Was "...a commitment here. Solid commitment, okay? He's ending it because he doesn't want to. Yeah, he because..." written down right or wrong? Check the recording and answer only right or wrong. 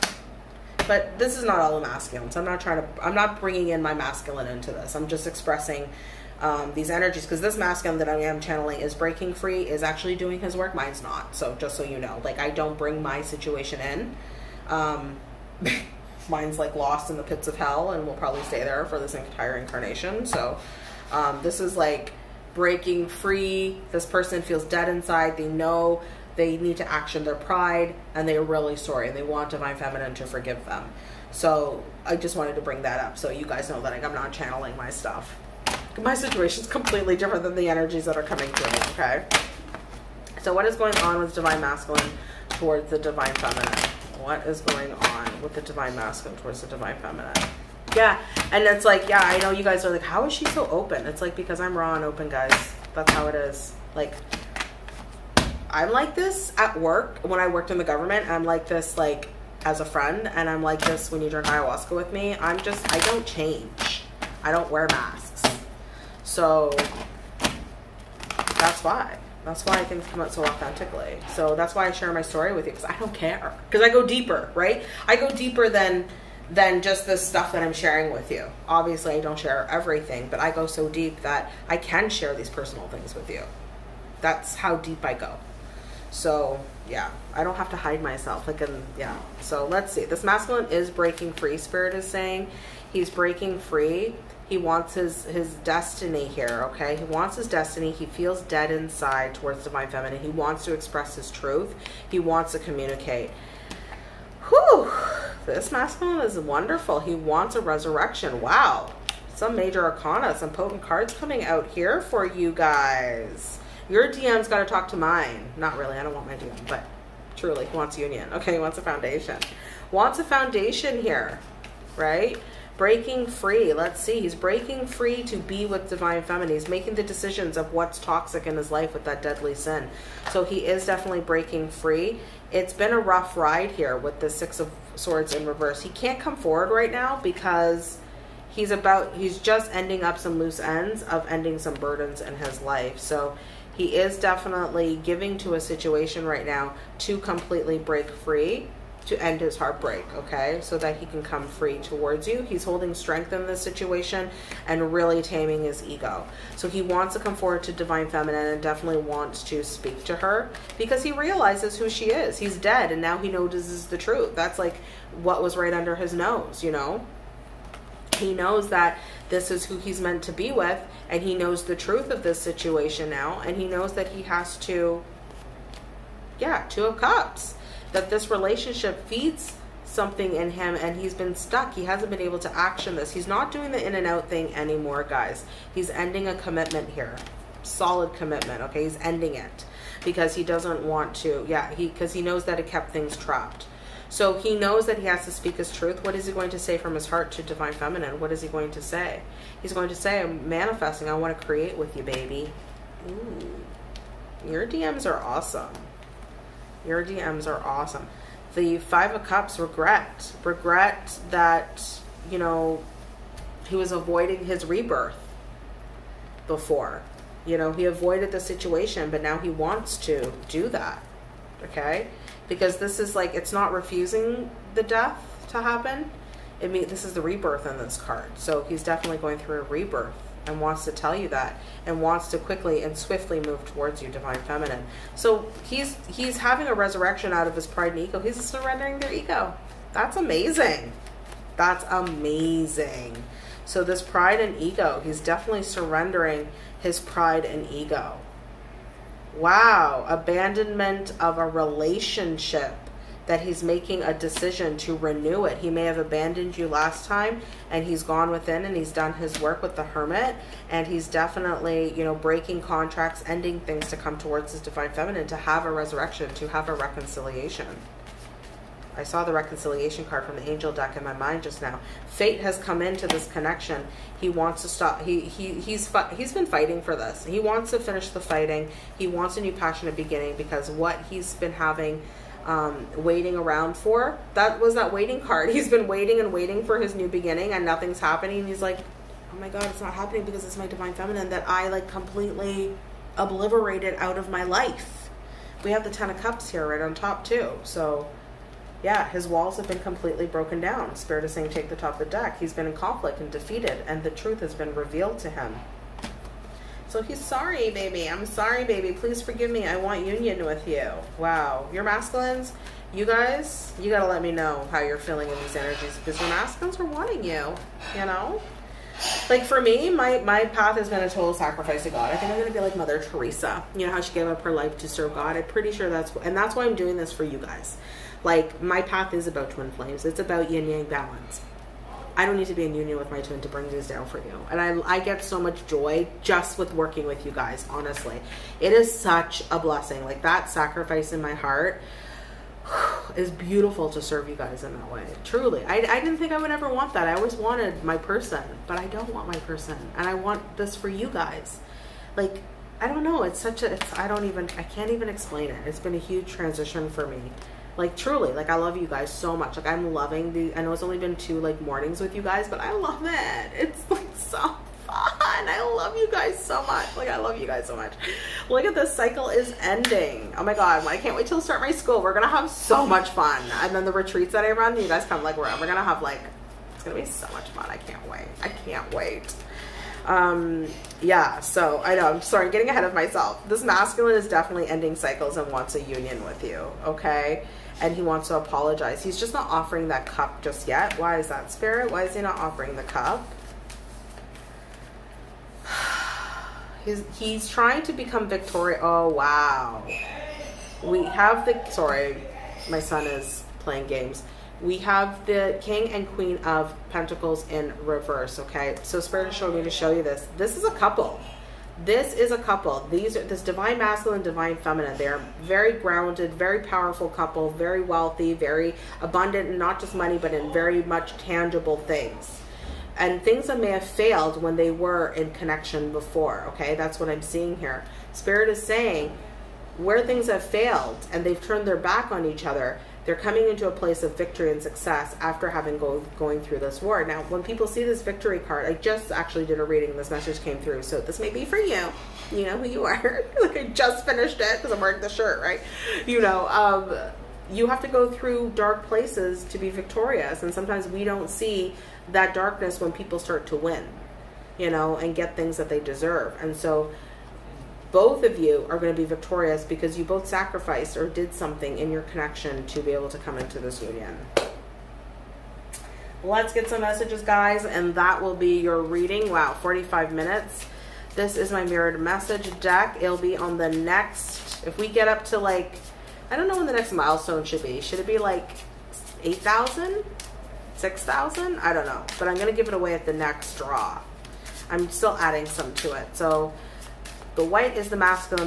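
right.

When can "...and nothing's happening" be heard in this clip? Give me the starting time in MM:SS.
04:47.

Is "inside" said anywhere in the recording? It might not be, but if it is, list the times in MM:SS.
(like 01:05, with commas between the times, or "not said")
00:24, 01:38.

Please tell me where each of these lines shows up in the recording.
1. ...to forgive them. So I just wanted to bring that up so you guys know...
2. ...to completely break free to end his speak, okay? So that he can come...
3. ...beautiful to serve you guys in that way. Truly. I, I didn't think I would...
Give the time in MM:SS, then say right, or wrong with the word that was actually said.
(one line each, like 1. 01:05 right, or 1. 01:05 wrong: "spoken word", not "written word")
1. 00:30 right
2. 02:26 wrong: "heartbreak", not "speak"
3. 05:43 right.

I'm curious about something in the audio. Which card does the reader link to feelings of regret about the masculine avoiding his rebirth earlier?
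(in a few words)
Five of Cups.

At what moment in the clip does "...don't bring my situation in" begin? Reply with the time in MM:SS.
00:12.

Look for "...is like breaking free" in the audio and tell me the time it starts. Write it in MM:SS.
00:21.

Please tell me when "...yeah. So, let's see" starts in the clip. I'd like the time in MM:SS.
01:28.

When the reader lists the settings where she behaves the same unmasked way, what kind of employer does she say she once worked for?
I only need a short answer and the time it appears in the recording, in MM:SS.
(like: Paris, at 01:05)
the government, at 00:57.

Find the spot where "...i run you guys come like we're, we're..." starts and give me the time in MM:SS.
06:14.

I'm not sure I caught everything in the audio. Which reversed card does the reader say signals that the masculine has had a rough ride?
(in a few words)
Six of Swords.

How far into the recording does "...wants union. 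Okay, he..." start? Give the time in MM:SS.
01:57.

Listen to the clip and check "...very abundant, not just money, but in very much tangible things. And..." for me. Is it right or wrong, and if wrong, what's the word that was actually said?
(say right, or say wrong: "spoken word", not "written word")
right.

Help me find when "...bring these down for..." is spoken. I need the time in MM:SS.
05:33.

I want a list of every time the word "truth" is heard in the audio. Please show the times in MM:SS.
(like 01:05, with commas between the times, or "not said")
01:41, 02:43, 02:51, 03:15, 05:04.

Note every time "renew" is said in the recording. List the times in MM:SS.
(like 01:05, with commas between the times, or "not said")
04:14.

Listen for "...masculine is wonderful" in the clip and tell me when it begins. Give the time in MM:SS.
01:45.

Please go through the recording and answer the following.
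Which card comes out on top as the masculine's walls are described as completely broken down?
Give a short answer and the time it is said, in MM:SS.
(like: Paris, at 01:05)
Ten of Cups, at 04:55.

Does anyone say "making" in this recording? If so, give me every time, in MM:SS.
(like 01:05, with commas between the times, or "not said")
02:06, 04:13.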